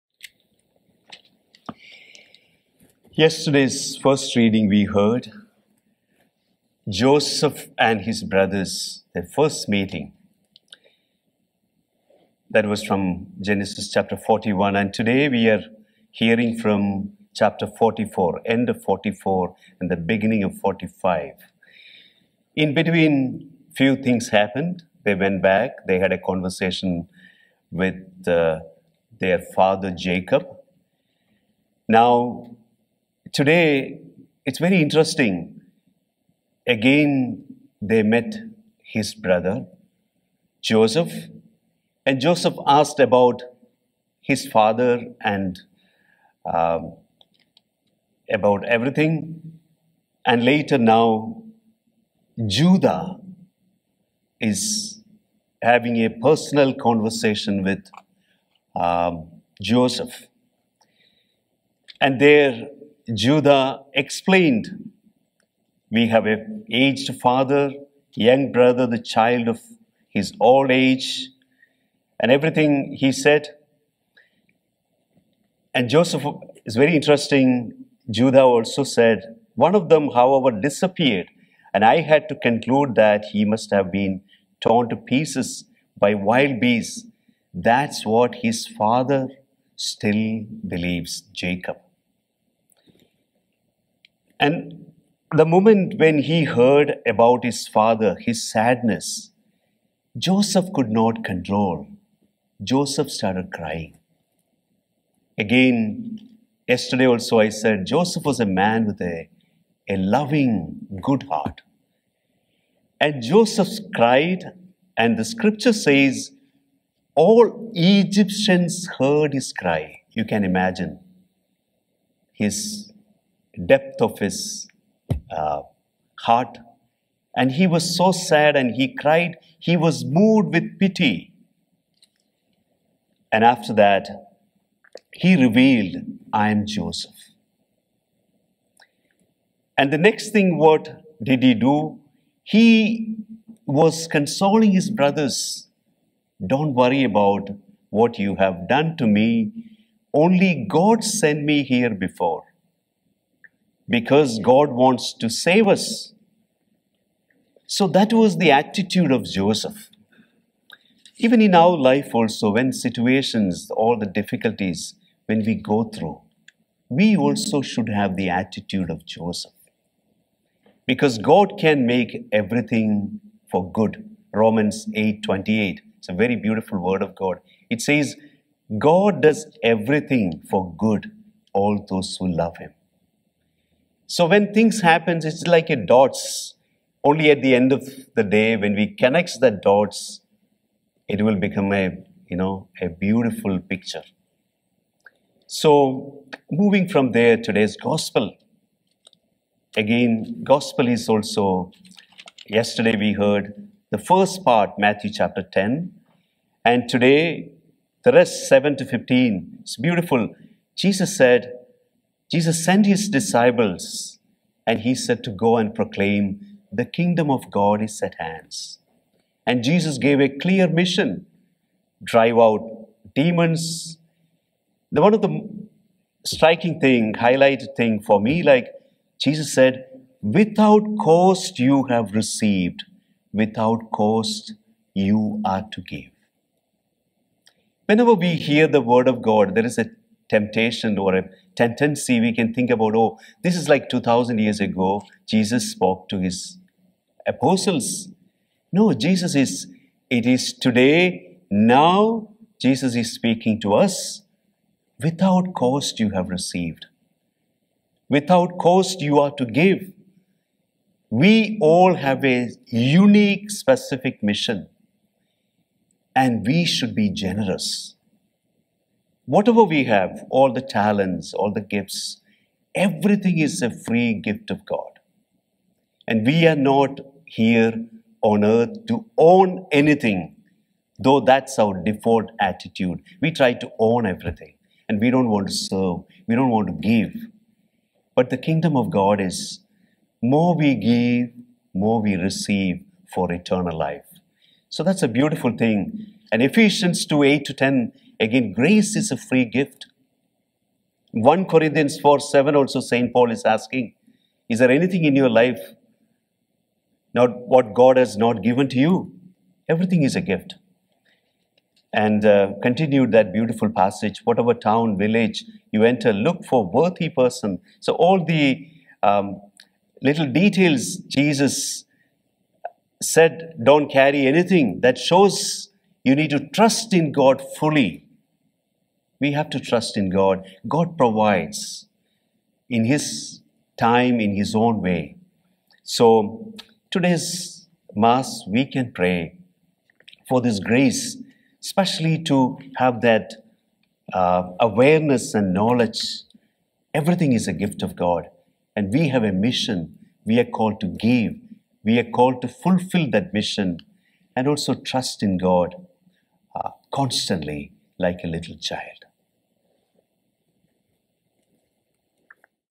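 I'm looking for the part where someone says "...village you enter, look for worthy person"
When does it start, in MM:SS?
05:14.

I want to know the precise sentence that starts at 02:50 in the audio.
Because God can make everything for good.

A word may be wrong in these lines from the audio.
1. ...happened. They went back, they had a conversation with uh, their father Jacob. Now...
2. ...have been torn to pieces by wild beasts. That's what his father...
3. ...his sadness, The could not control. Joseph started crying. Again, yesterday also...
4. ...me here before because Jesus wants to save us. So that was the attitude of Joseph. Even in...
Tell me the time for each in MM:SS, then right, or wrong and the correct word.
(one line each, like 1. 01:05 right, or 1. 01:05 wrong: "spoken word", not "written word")
1. 00:24 right
2. 01:23 right
3. 01:38 wrong: "Joseph", not "The"
4. 02:31 wrong: "God", not "Jesus".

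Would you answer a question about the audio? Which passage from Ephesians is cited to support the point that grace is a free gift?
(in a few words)
Ephesians 2:8-10.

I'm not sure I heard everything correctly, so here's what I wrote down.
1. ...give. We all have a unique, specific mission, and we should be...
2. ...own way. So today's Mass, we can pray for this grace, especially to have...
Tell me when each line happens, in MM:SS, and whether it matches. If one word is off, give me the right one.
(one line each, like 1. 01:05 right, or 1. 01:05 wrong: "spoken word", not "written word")
1. 04:19 right
2. 05:34 right.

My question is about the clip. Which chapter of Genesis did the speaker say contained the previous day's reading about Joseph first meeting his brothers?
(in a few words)
41.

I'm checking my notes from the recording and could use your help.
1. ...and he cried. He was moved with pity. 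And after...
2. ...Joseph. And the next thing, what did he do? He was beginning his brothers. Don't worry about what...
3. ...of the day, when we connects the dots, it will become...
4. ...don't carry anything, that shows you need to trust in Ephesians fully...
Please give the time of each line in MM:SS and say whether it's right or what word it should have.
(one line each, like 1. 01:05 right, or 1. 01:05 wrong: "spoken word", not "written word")
1. 02:08 right
2. 02:16 wrong: "consoling", not "beginning"
3. 03:07 right
4. 05:23 wrong: "God", not "Ephesians".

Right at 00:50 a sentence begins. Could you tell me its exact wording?
And later, now, Judah is having a personal conversation with um, Joseph.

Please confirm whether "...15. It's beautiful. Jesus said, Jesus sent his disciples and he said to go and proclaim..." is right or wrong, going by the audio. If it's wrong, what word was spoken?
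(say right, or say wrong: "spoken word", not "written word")
right.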